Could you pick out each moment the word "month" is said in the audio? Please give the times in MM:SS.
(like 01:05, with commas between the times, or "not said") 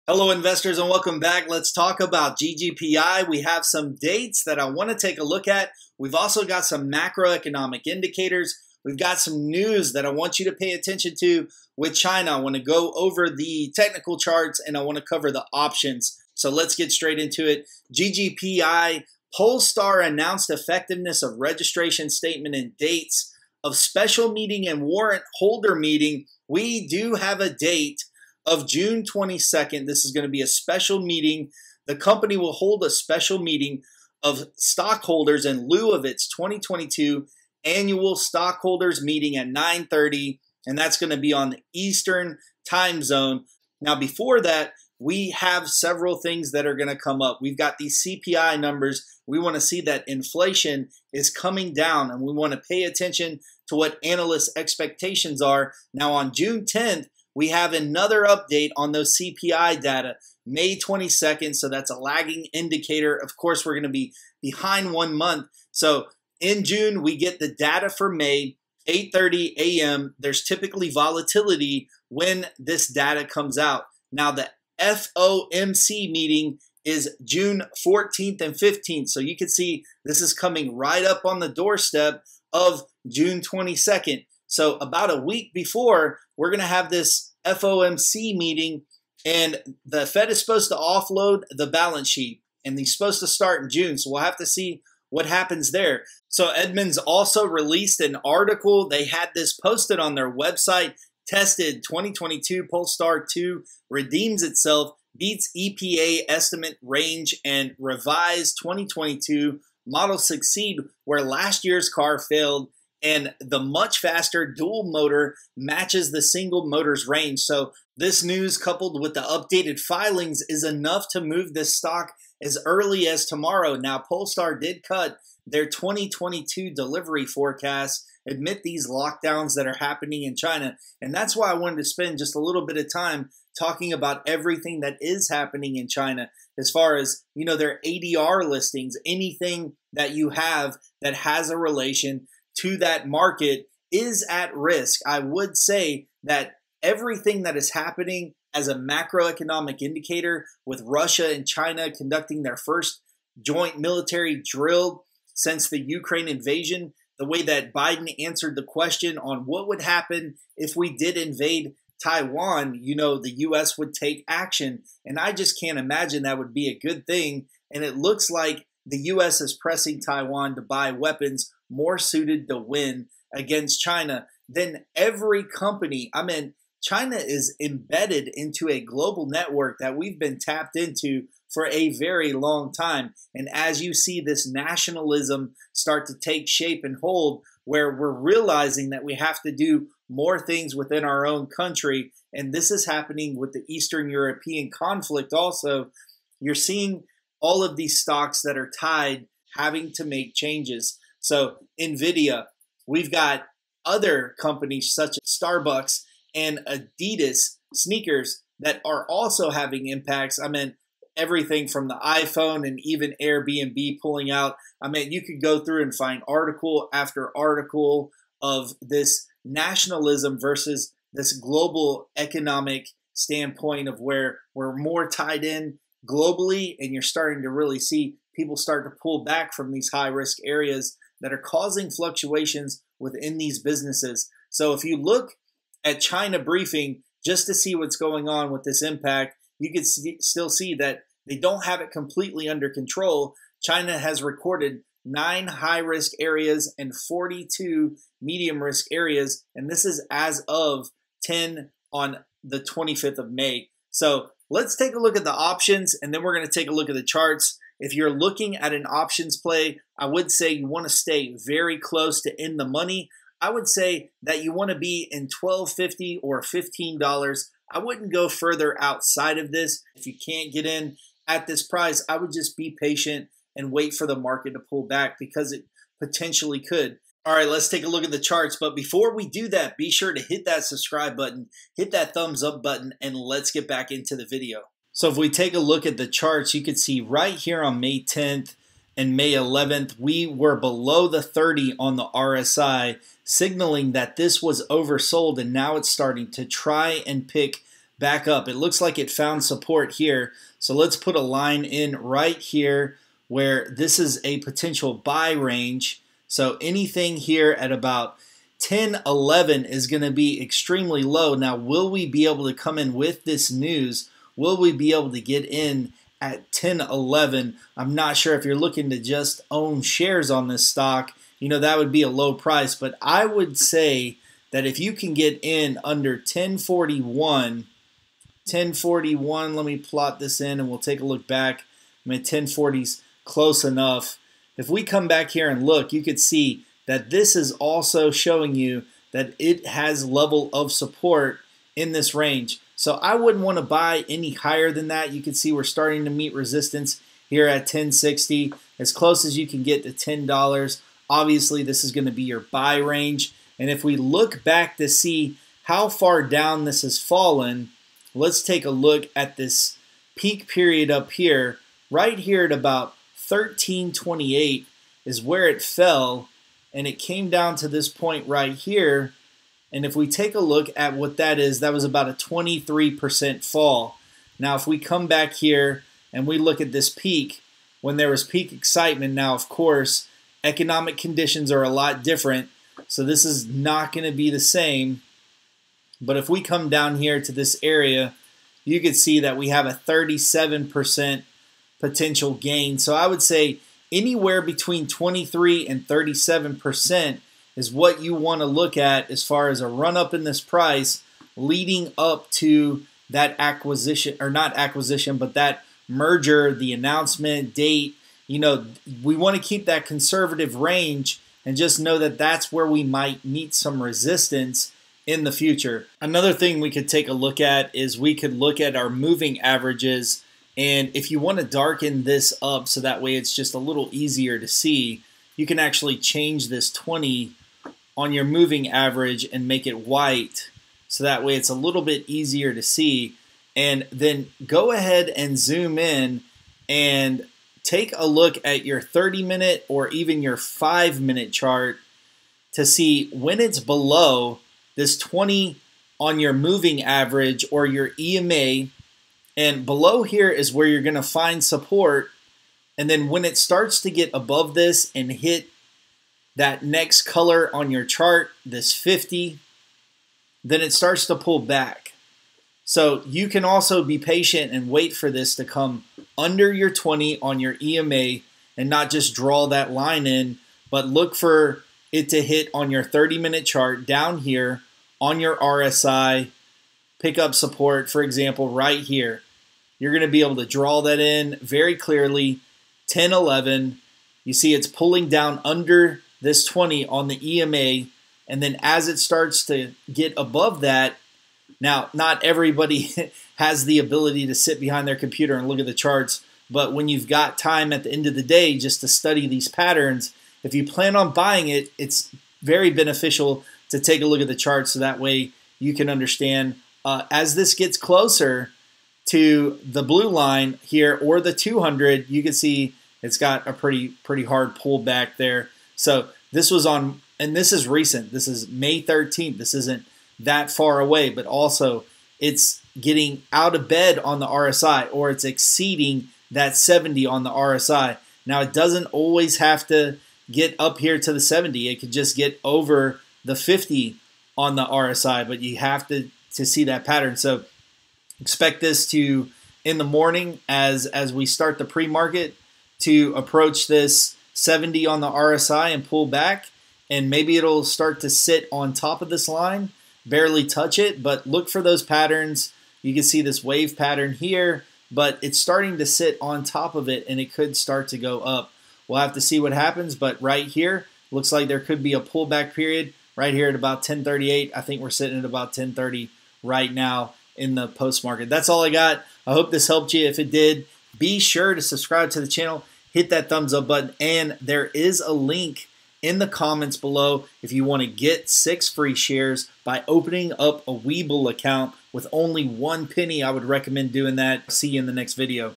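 01:05.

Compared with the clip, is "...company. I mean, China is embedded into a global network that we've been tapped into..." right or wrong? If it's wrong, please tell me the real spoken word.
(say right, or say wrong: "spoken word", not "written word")
right.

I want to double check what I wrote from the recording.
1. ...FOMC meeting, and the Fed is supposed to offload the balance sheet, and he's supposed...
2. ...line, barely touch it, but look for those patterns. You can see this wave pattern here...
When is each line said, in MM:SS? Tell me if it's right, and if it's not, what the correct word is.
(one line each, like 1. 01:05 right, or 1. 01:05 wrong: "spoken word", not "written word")
1. 01:27 right
2. 09:09 right.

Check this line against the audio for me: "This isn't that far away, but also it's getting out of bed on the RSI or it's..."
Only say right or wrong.
right.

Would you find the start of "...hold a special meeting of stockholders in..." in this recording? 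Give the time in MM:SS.
00:32.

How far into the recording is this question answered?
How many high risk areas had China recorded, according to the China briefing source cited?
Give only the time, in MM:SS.
04:05.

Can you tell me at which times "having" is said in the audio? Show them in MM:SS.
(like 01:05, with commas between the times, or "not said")
03:19, 03:29.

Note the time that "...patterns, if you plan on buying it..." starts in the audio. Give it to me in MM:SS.
08:19.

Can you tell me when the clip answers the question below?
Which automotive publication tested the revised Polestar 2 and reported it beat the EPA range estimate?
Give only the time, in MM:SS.
01:36.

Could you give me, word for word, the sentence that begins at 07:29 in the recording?
And below here is where you're going to find support.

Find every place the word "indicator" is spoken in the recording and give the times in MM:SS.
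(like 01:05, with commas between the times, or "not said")
00:07, 01:02, 02:29.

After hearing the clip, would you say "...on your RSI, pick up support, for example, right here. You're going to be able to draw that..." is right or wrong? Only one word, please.
right.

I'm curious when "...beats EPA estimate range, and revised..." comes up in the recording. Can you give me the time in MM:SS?
01:45.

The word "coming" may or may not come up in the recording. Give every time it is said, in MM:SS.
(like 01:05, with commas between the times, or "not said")
00:51, 01:20.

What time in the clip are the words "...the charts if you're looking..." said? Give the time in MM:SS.
04:16.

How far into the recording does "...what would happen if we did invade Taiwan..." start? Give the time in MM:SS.
02:39.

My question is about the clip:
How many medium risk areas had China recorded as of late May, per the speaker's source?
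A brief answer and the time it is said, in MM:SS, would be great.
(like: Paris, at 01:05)
42, at 04:06.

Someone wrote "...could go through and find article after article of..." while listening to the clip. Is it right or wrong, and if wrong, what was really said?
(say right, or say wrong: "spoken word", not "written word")
right.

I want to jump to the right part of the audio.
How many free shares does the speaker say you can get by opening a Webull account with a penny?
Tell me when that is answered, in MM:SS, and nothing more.
09:38.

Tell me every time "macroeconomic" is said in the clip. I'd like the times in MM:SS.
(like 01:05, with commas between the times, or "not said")
00:06, 02:28.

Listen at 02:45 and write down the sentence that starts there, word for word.
And I just can't imagine that would be a good thing.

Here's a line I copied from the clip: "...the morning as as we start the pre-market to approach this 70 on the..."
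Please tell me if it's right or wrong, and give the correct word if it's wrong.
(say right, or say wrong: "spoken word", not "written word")
right.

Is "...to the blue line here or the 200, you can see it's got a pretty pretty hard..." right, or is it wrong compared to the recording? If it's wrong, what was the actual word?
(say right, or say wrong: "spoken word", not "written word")
right.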